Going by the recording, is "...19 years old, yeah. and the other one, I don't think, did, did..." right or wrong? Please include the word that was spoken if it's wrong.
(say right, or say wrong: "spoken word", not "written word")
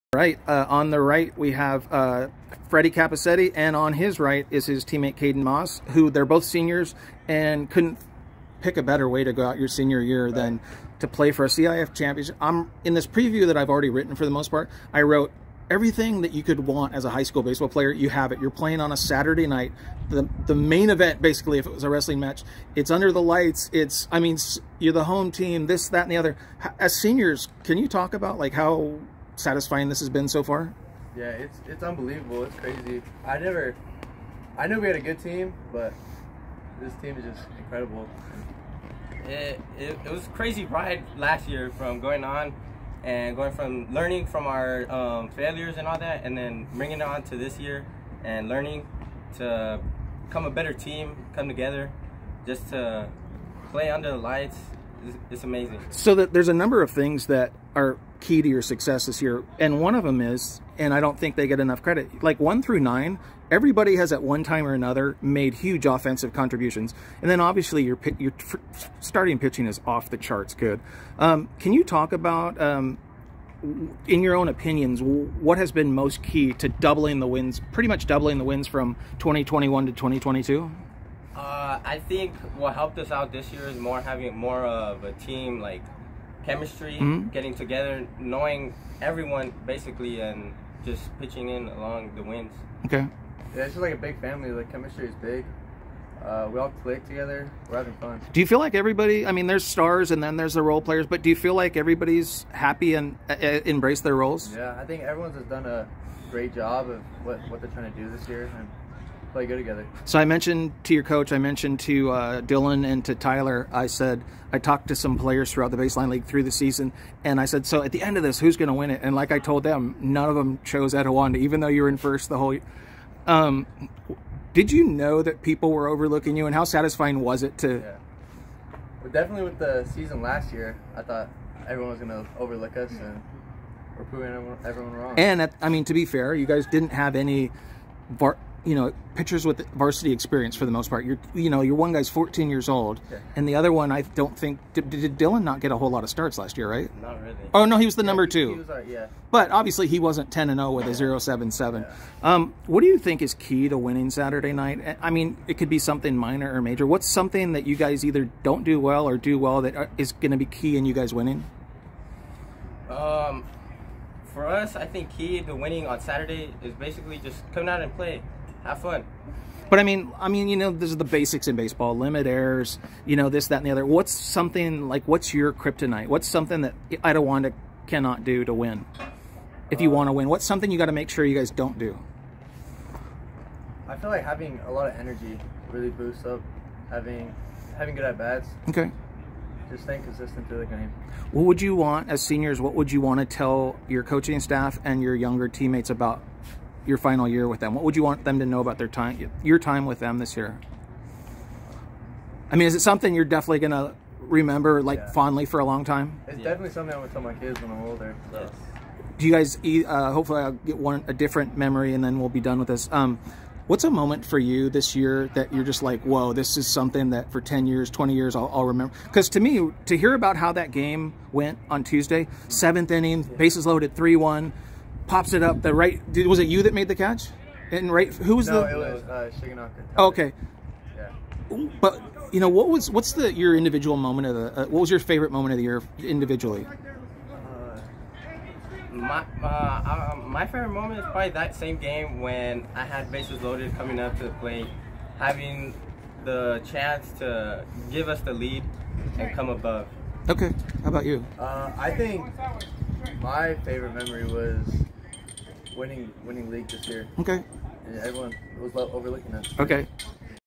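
wrong: "14", not "19".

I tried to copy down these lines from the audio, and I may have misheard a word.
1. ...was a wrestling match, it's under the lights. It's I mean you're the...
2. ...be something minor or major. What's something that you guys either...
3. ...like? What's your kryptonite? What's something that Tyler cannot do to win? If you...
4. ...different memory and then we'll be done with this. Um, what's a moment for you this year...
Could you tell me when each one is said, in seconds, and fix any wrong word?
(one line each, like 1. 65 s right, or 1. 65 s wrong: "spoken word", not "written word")
1. 21 s right
2. 155 s right
3. 174 s wrong: "Etiwanda", not "Tyler"
4. 211 s right.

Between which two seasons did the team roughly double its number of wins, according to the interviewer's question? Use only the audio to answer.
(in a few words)
2021 to 2022.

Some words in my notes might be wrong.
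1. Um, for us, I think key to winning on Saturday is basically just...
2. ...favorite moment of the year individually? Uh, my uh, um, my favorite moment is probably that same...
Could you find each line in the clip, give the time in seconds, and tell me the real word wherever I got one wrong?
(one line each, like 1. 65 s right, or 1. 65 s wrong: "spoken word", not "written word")
1. 162 s right
2. 235 s right.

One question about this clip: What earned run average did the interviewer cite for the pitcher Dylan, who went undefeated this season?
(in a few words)
0.77.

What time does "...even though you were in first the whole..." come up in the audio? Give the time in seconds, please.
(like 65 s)
121 s.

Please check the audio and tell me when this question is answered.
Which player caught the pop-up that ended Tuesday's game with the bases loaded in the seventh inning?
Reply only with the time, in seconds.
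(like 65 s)
229 s.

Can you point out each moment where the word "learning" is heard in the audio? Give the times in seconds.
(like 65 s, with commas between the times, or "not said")
43 s, 48 s.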